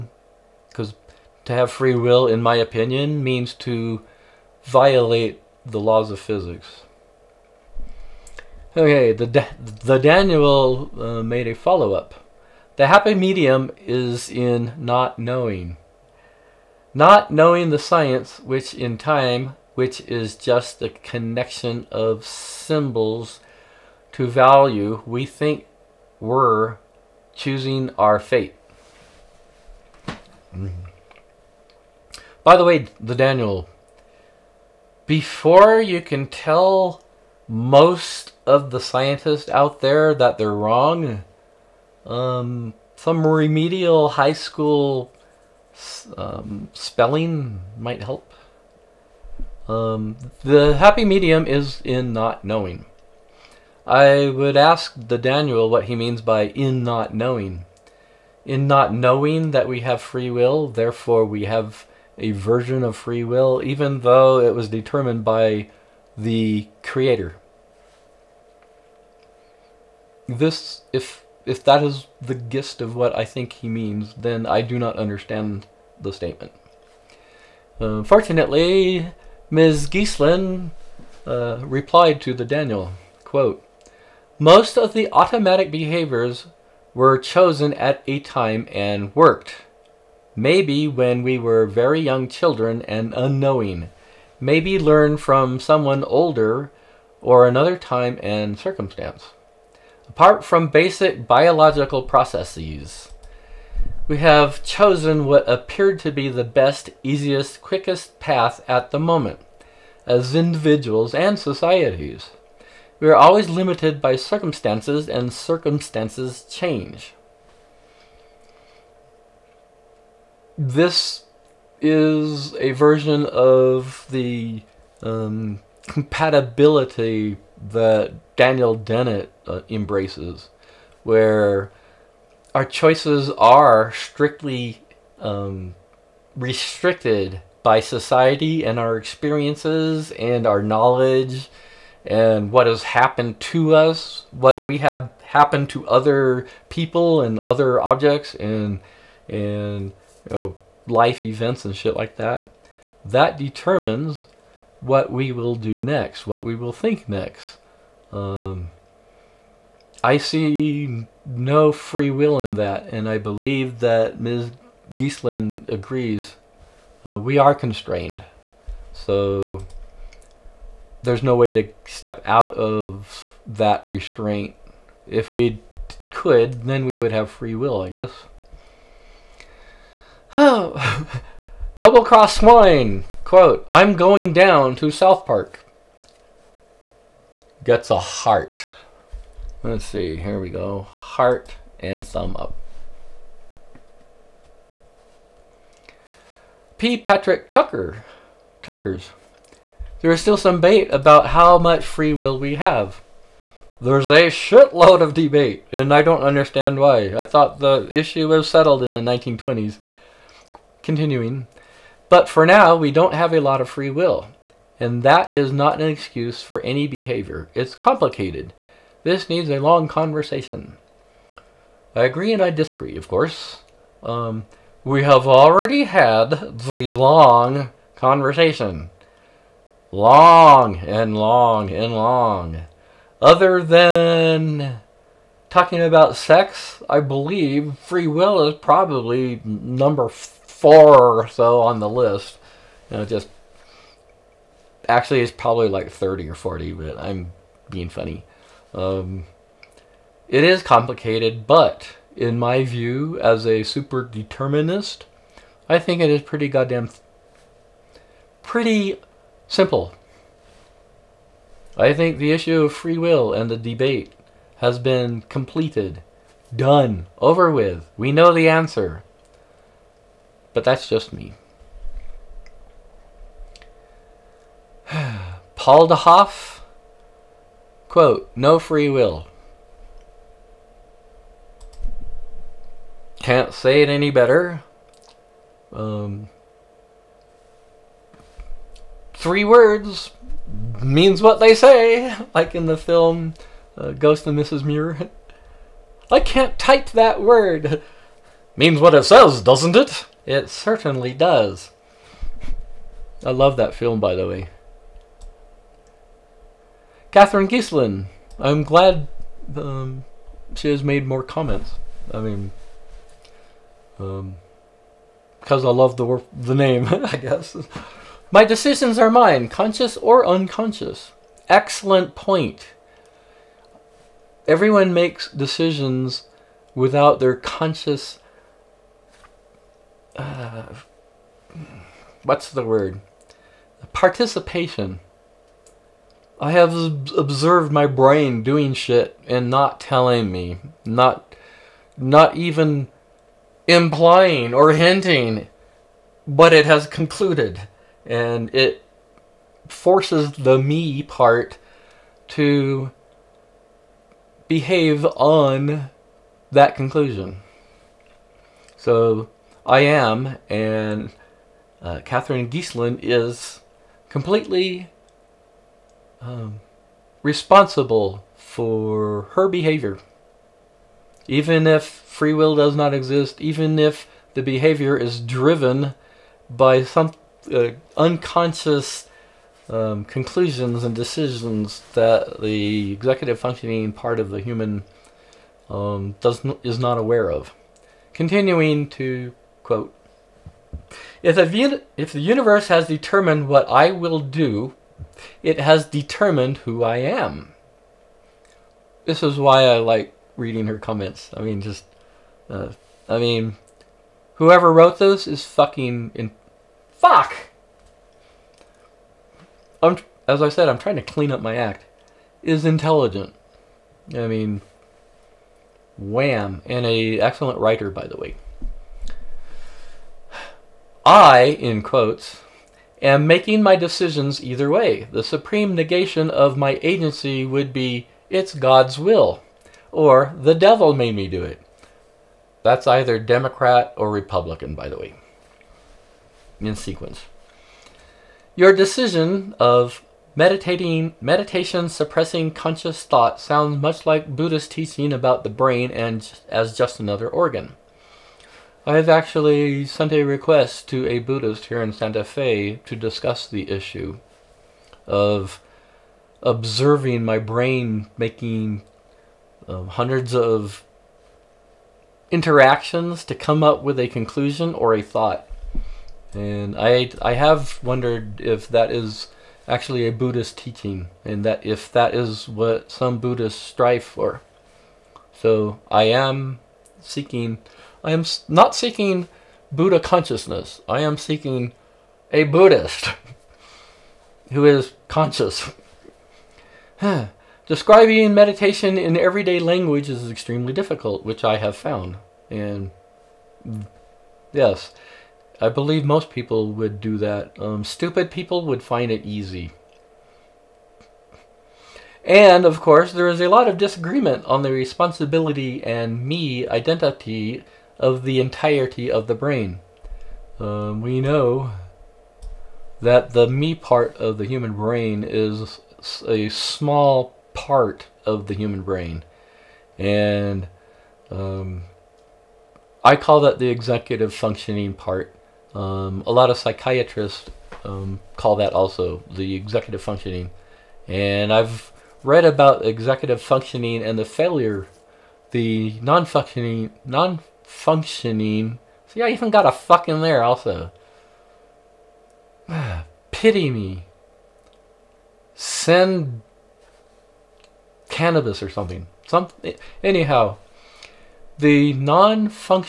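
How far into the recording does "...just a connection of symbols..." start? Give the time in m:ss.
0:20.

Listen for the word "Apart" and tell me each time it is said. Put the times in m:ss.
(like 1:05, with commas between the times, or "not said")
1:40.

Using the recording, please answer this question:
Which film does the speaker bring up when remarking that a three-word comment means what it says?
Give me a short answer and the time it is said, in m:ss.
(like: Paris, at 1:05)
Ghost and Mrs. Muir, at 4:53.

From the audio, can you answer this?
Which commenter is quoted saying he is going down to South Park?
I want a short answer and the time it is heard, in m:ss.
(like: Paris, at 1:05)
Double Cross Swine, at 3:01.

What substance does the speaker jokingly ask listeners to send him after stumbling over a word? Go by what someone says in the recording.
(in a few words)
Cannabis.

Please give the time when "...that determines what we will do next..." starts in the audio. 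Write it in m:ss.
2:33.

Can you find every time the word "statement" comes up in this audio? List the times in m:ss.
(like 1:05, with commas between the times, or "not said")
1:16.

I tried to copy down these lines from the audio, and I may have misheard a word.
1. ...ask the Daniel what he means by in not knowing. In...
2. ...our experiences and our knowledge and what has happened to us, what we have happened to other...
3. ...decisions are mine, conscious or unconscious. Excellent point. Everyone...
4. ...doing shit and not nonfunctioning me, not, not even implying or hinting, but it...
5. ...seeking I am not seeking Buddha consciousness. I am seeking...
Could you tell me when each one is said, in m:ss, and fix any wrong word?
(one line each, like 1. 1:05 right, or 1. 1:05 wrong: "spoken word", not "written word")
1. 0:54 right
2. 2:18 right
3. 5:18 right
4. 5:38 wrong: "telling", not "nonfunctioning"
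5. 7:57 right.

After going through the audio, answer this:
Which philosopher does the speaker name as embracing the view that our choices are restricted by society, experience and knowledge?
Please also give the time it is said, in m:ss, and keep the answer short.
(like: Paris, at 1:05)
Daniel Dennett, at 2:08.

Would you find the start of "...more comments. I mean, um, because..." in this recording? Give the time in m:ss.
5:11.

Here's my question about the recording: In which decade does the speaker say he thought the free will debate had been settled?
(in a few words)
1920s.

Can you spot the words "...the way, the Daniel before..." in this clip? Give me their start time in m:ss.
0:32.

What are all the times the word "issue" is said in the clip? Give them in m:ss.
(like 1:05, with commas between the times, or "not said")
3:27, 4:22, 7:33.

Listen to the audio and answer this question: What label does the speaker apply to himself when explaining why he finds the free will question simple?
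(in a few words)
Super determinist.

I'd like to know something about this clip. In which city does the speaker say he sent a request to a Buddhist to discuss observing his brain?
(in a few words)
Santa Fe.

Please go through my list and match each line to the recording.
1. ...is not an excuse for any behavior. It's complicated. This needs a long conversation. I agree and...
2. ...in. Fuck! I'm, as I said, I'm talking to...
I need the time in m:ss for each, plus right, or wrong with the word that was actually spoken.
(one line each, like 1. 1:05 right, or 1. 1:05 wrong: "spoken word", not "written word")
1. 3:35 right
2. 6:46 wrong: "trying", not "talking".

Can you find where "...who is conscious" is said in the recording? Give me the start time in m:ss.
8:04.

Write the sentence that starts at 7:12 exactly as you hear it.
That's either Democrat or Republican, by the way, in sequence.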